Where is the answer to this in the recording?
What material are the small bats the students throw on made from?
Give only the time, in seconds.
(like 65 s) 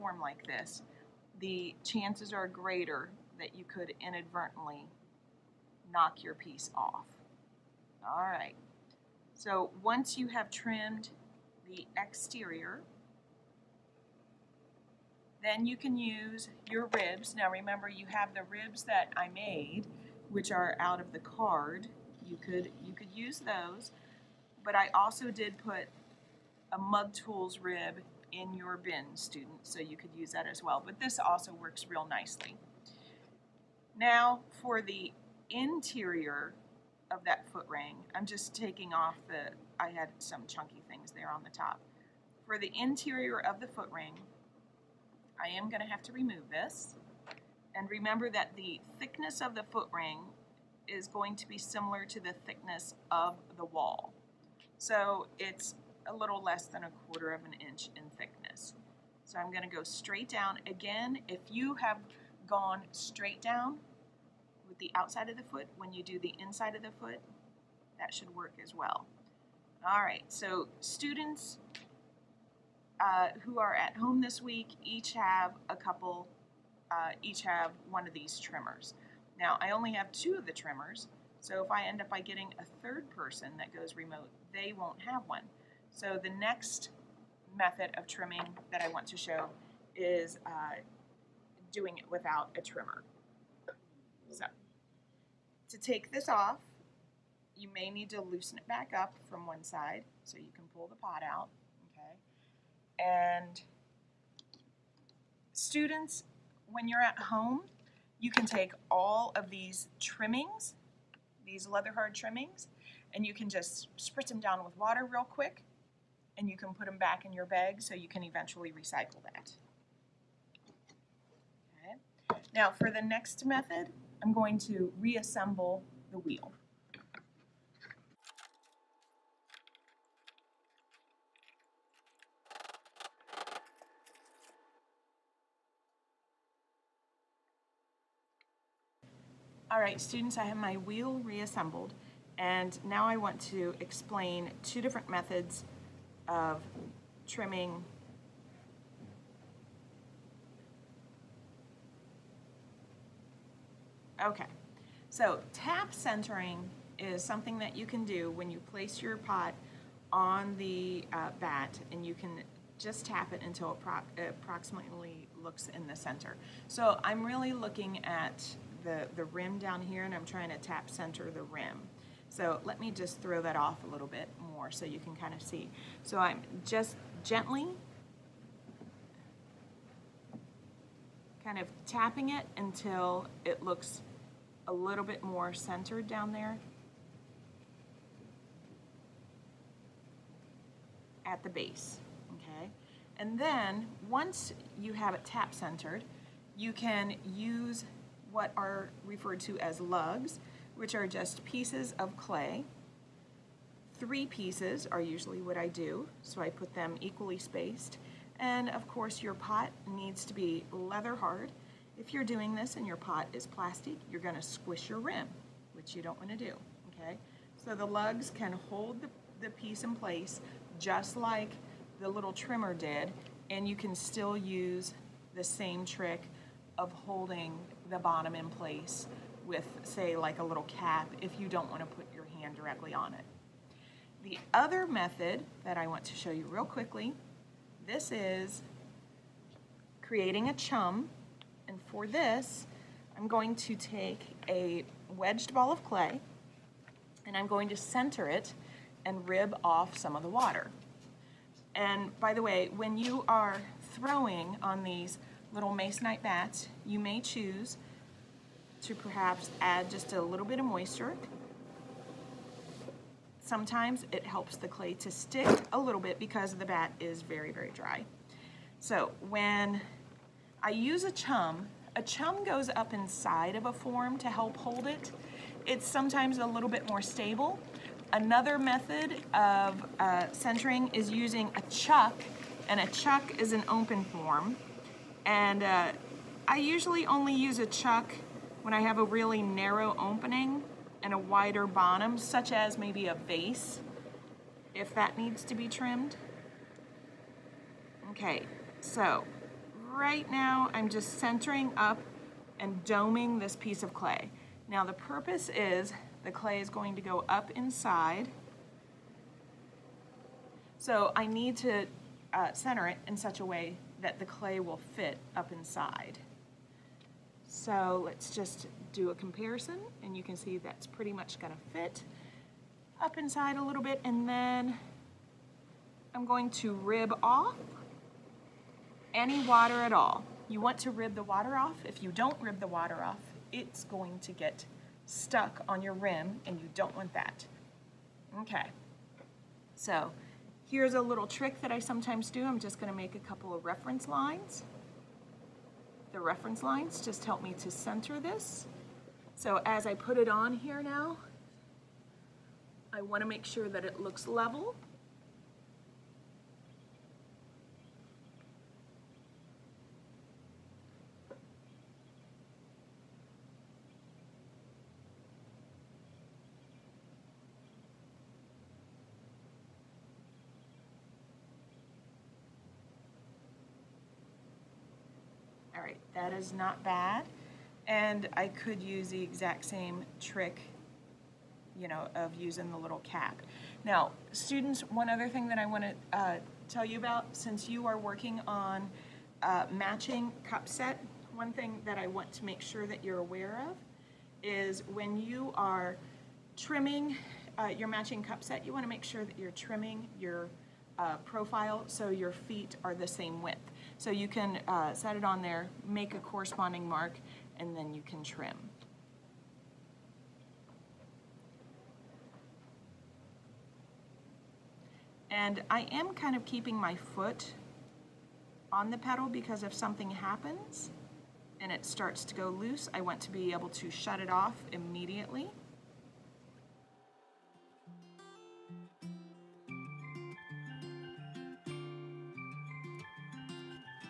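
255 s.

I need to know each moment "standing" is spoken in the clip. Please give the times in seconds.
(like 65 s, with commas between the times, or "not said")
not said.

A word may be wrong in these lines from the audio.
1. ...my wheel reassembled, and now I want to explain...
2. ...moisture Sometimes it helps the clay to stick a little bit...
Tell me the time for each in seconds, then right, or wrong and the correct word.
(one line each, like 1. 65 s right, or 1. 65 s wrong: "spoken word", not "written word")
1. 140 s right
2. 260 s right.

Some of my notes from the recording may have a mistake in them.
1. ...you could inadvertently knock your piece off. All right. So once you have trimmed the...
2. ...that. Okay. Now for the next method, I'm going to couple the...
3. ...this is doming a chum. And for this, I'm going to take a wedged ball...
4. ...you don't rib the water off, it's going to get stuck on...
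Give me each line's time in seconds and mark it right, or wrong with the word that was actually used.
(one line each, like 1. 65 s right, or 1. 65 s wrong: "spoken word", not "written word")
1. 3 s right
2. 119 s wrong: "reassemble", not "couple"
3. 237 s wrong: "creating", not "doming"
4. 332 s right.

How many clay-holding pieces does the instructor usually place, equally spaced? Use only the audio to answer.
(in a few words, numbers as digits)
3.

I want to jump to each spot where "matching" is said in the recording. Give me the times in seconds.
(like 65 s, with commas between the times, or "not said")
389 s, 397 s.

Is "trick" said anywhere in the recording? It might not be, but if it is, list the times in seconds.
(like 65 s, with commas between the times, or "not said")
225 s, 341 s, 380 s.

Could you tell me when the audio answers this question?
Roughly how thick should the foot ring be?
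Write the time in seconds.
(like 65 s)
56 s.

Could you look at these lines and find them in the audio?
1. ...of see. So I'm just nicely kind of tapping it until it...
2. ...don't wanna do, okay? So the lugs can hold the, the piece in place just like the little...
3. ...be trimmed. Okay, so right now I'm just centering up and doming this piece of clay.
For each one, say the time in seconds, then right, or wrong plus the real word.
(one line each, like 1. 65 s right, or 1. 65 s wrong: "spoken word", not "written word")
1. 175 s wrong: "gently", not "nicely"
2. 216 s right
3. 295 s right.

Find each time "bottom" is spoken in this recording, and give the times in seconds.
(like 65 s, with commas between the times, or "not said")
227 s, 291 s.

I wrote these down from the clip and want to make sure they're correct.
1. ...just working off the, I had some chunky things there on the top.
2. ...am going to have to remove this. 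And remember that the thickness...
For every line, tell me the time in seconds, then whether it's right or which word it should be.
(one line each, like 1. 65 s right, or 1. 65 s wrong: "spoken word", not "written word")
1. 38 s wrong: "taking", not "working"
2. 45 s right.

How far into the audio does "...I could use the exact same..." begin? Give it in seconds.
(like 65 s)
378 s.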